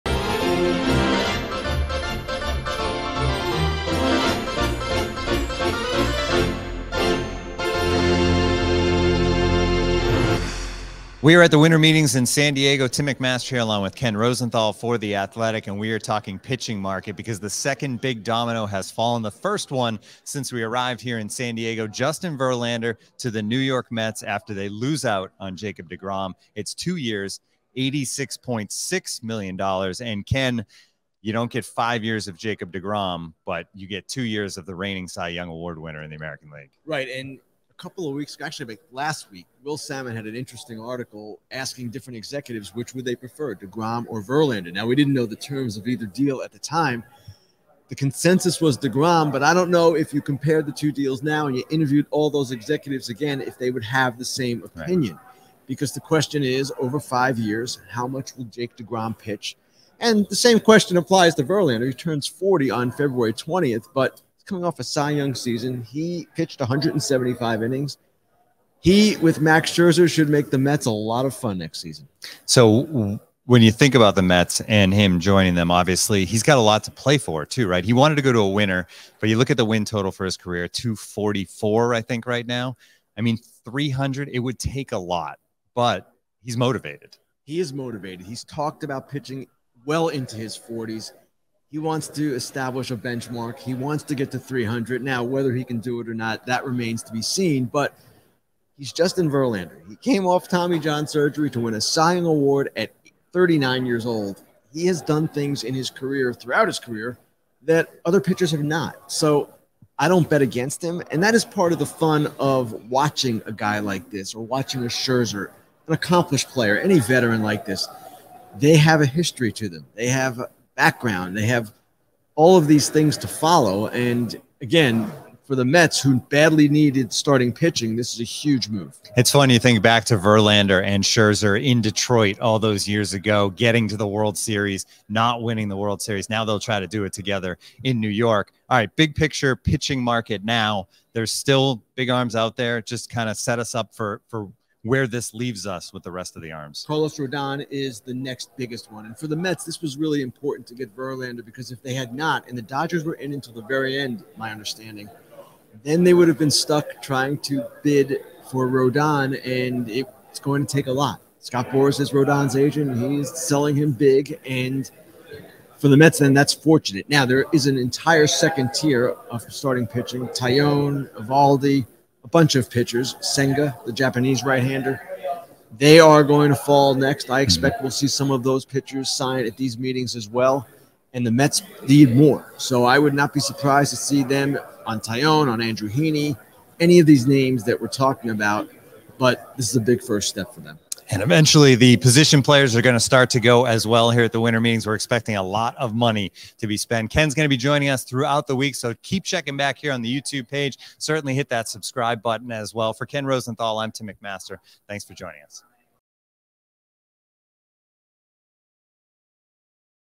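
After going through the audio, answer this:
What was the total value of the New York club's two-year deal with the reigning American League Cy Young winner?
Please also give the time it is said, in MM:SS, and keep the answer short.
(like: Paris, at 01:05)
$86.6 million, at 00:27.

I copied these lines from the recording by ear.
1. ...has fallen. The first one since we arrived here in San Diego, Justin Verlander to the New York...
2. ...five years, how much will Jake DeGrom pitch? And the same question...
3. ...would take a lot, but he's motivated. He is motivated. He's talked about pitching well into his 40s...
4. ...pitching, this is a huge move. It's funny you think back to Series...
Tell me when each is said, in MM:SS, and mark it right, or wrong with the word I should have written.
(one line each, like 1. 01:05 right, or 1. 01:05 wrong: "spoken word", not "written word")
1. 00:18 right
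2. 00:56 right
3. 01:24 right
4. 02:07 wrong: "Verlander", not "Series".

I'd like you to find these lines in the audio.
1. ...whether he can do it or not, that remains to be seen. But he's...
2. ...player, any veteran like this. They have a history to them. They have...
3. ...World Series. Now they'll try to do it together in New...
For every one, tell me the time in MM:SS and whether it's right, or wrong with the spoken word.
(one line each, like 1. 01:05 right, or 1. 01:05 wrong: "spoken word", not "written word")
1. 01:35 right
2. 01:56 right
3. 02:15 right.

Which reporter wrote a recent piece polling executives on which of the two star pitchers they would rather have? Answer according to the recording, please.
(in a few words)
Will Sammon.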